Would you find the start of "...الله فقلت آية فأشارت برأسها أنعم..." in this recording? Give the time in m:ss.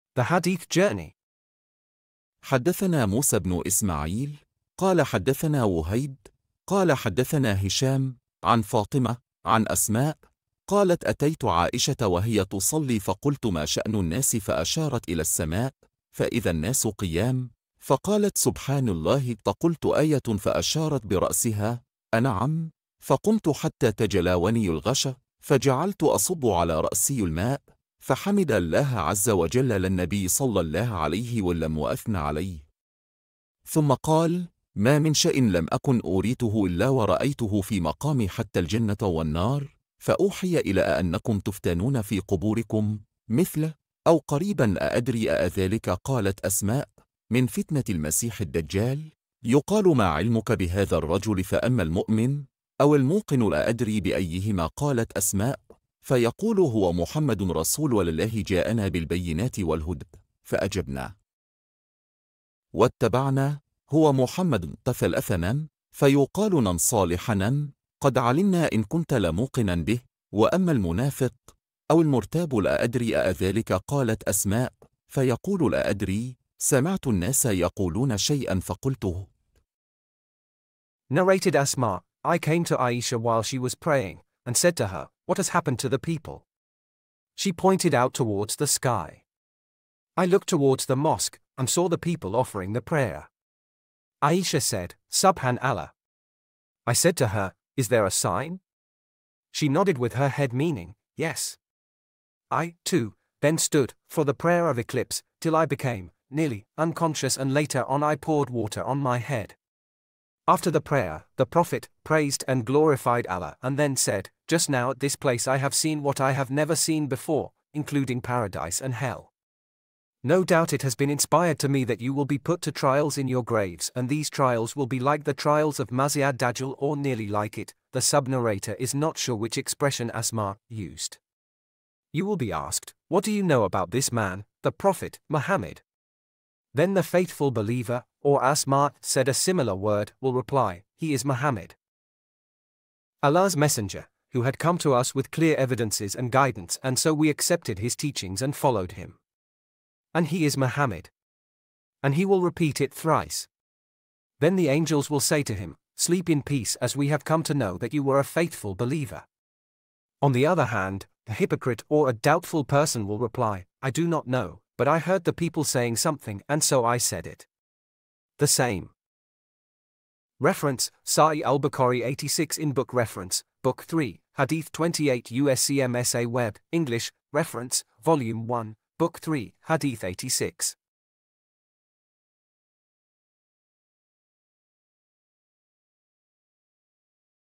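0:18.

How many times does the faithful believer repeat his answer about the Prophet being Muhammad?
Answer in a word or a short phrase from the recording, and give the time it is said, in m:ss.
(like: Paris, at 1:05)
3 times, at 2:32.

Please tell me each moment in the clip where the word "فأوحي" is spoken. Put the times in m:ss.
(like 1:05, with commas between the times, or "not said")
0:40.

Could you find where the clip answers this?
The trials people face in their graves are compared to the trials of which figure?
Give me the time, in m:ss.
2:05.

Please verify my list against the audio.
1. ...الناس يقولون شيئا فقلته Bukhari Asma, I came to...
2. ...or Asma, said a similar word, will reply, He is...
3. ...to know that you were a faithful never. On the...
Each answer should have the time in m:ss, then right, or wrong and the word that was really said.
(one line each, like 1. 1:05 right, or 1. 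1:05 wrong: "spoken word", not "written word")
1. 1:17 wrong: "Narrated", not "Bukhari"
2. 2:18 right
3. 2:37 wrong: "believer", not "never".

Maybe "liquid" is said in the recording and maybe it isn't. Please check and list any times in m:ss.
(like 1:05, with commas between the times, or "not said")
not said.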